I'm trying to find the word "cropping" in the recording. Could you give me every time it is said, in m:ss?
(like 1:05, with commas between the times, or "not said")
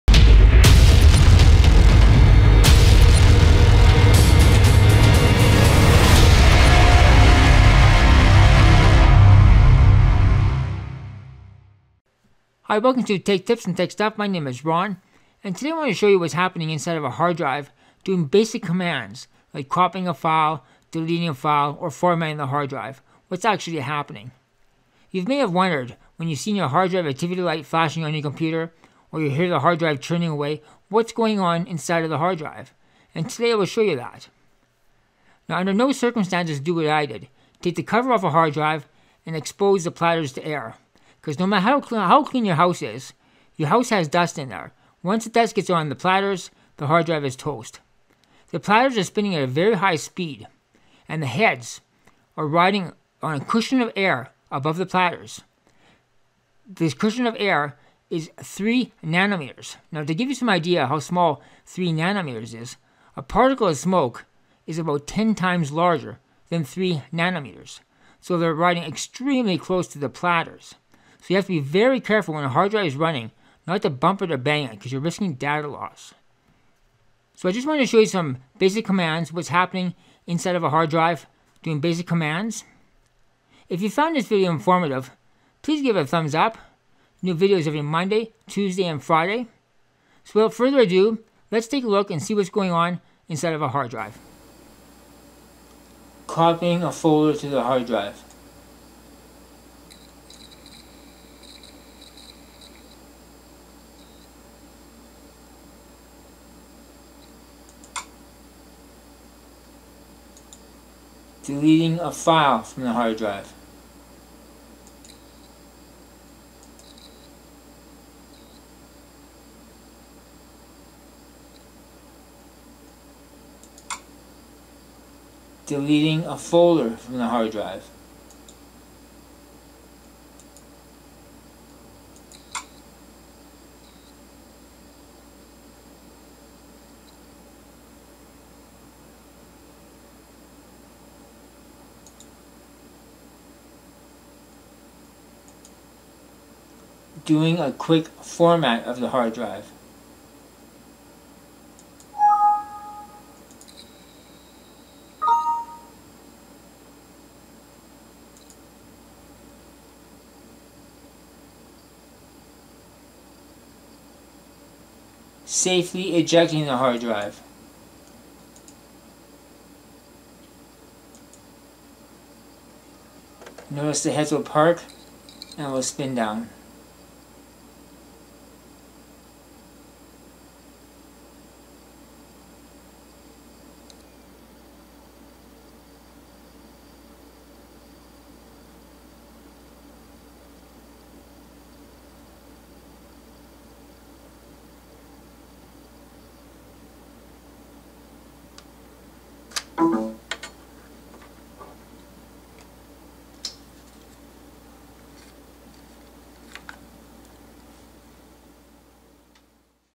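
0:19.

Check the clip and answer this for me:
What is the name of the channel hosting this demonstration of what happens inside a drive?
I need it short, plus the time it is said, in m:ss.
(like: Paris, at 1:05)
Tech Tips and Tech Stuff, at 0:13.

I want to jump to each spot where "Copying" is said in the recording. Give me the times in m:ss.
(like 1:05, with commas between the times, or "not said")
1:36.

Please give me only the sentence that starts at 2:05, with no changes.
Deleting a folder from the hard drive.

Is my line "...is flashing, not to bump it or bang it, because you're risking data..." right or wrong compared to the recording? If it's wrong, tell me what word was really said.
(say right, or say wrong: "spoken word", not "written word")
wrong: "running", not "flashing".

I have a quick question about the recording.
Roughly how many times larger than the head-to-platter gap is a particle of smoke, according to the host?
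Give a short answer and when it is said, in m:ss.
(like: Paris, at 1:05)
10 times, at 1:05.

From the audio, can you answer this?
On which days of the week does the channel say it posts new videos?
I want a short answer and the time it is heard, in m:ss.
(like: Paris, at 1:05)
Monday, Tuesday, and Friday, at 1:27.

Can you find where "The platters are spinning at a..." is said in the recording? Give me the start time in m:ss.
0:48.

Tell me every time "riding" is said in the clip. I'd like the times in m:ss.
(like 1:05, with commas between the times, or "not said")
0:52, 1:08.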